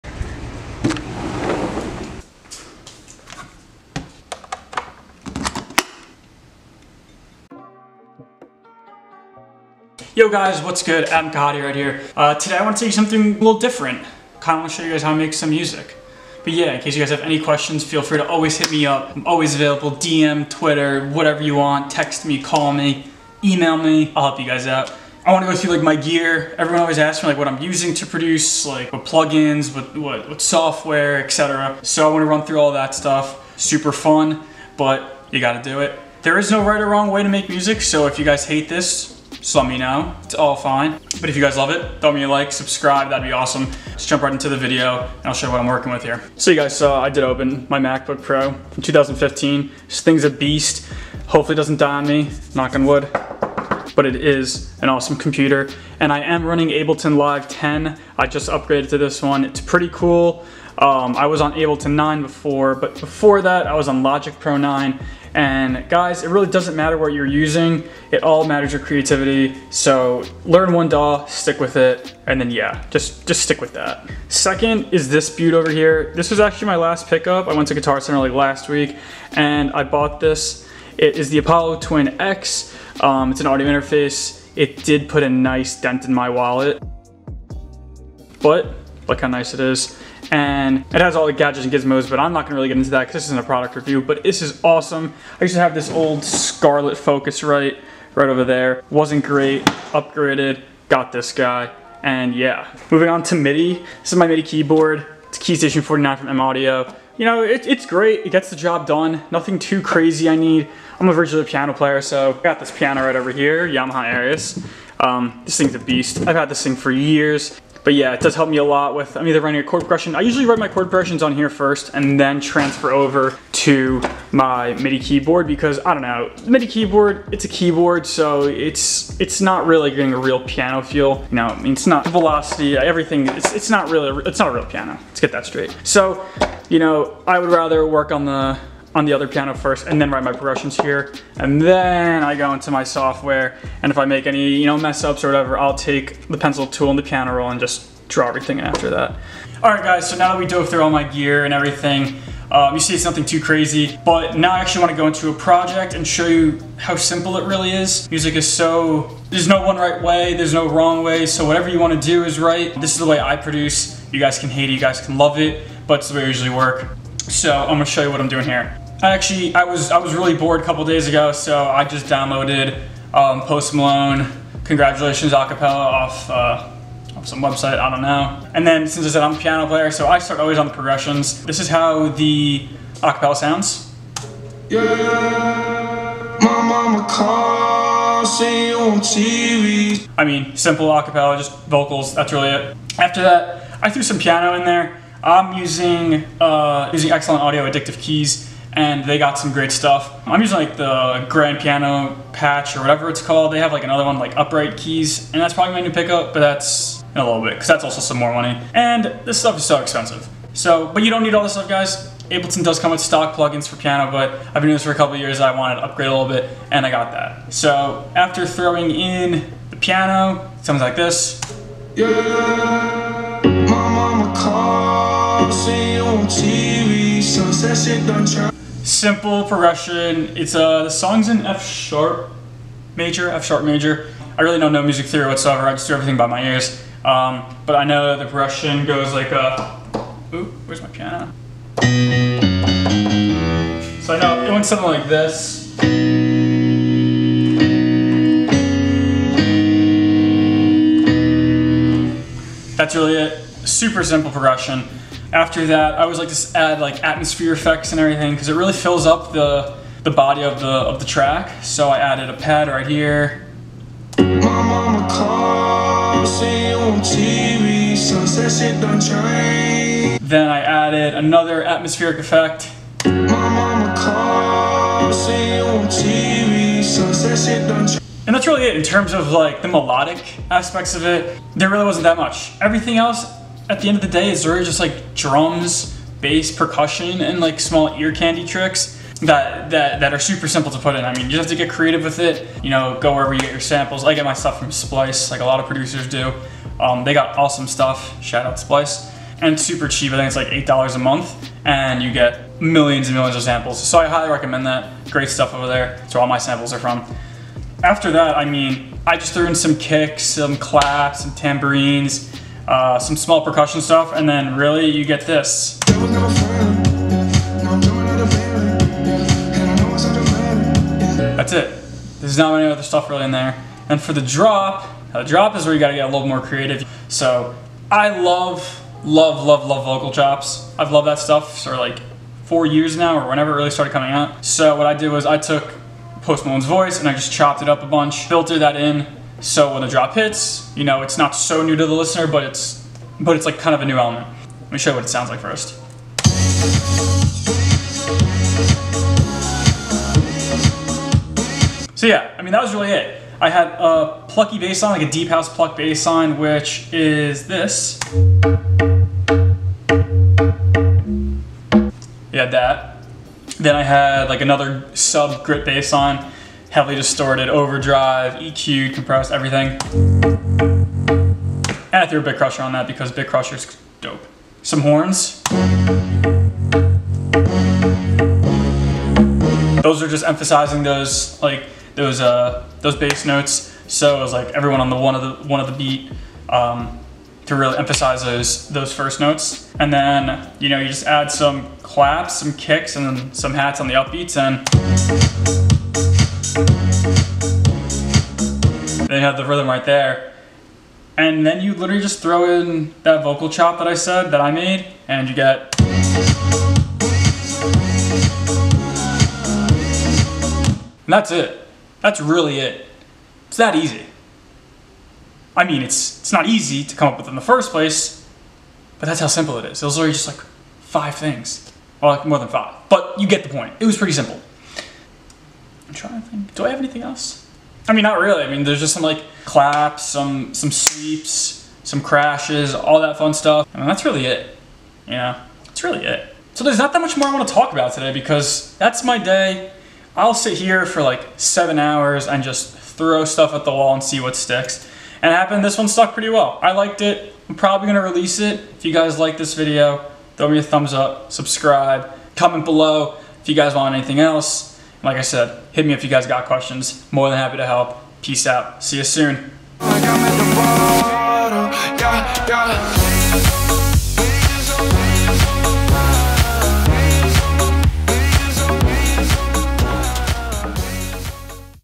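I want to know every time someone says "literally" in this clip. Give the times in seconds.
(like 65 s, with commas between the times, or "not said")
401 s, 419 s.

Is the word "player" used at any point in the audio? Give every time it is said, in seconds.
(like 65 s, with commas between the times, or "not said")
111 s, 179 s.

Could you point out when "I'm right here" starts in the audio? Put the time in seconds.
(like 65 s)
11 s.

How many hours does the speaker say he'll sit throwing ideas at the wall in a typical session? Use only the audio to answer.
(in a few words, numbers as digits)
7.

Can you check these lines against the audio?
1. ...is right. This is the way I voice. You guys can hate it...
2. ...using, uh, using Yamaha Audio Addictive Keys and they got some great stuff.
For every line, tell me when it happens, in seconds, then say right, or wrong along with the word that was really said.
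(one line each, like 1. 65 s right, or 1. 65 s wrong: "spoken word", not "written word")
1. 162 s wrong: "produce", not "voice"
2. 195 s wrong: "XLN", not "Yamaha".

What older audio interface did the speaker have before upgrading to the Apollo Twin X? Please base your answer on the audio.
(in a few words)
Scarlett Focusrite.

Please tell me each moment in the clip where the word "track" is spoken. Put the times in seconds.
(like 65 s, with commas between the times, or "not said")
261 s.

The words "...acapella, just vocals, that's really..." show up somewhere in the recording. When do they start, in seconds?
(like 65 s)
190 s.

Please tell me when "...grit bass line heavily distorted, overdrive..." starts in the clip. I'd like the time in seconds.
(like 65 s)
365 s.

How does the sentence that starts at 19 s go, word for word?
I'm always available, DM, Twitter, whatever you want.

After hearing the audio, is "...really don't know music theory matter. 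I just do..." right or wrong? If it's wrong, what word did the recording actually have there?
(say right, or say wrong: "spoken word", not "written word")
wrong: "whatsoever", not "matter".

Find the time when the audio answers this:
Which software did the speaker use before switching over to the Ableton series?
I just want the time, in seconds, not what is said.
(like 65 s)
64 s.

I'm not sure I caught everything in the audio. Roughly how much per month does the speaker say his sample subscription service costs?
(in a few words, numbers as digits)
$8.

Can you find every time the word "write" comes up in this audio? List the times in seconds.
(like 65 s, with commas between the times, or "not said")
120 s, 140 s.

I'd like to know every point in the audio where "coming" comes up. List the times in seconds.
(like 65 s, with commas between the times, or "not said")
333 s.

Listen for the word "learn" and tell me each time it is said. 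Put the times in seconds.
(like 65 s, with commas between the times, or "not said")
70 s.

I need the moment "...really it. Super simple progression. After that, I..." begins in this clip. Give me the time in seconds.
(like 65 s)
252 s.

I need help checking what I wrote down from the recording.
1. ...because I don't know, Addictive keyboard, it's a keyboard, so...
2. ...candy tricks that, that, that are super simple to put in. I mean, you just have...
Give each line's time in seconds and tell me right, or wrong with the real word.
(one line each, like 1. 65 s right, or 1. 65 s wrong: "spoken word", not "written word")
1. 125 s wrong: "MIDI", not "Addictive"
2. 288 s right.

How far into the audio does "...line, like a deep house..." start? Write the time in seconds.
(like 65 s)
354 s.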